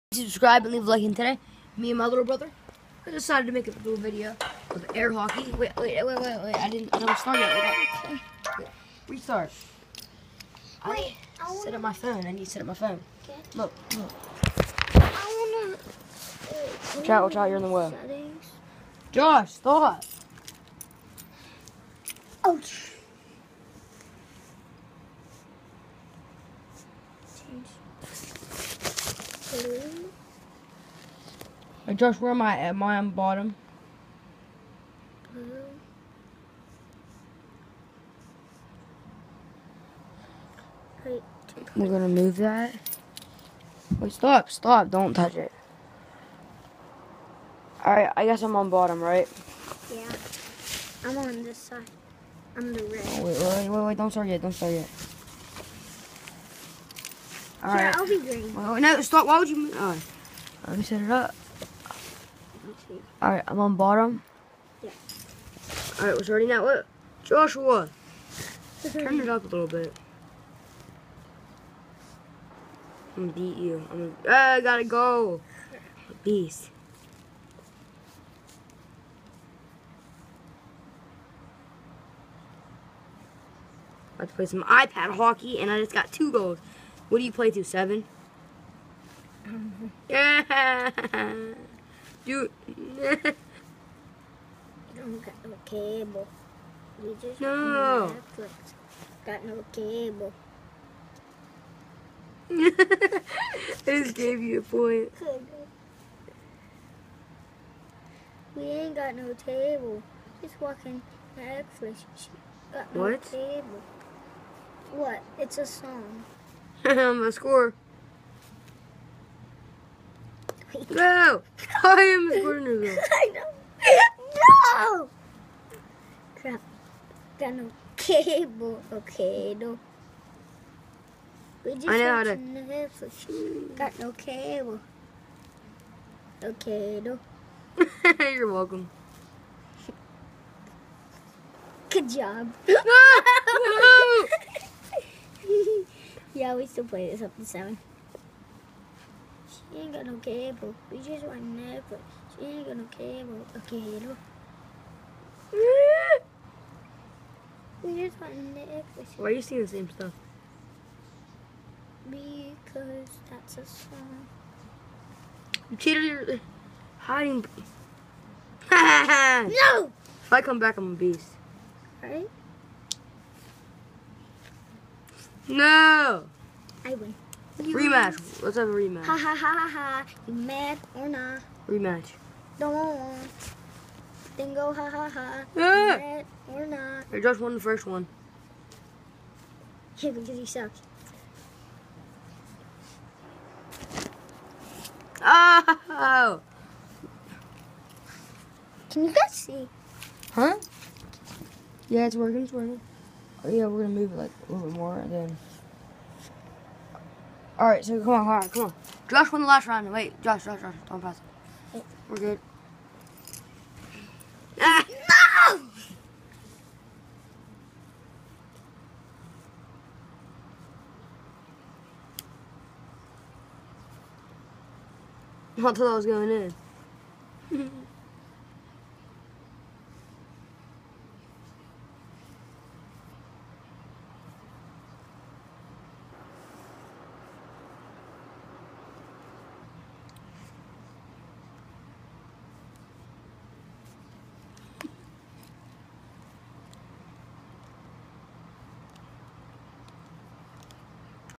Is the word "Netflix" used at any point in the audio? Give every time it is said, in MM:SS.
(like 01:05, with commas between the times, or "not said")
01:38, 01:51, 02:12, 02:31, 02:38.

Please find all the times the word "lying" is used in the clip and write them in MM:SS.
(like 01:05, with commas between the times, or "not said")
not said.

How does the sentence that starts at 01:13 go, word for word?
I'm gonna, uh, I gotta go.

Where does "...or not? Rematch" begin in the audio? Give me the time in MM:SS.
03:00.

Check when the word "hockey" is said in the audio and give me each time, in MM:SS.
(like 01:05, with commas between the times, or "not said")
00:05, 01:25.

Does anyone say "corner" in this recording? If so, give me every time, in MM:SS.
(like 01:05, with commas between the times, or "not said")
02:02.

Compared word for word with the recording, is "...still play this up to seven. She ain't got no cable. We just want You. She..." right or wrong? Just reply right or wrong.
wrong.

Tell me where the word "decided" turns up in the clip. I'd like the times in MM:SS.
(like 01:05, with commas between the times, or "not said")
00:03.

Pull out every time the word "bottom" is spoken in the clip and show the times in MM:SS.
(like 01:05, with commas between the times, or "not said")
00:33, 00:48, 01:03.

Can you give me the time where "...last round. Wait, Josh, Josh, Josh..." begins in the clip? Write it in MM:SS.
03:29.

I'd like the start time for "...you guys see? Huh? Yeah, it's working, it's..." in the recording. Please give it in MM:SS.
03:19.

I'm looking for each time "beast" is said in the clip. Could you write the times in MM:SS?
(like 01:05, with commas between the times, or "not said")
01:16, 02:50.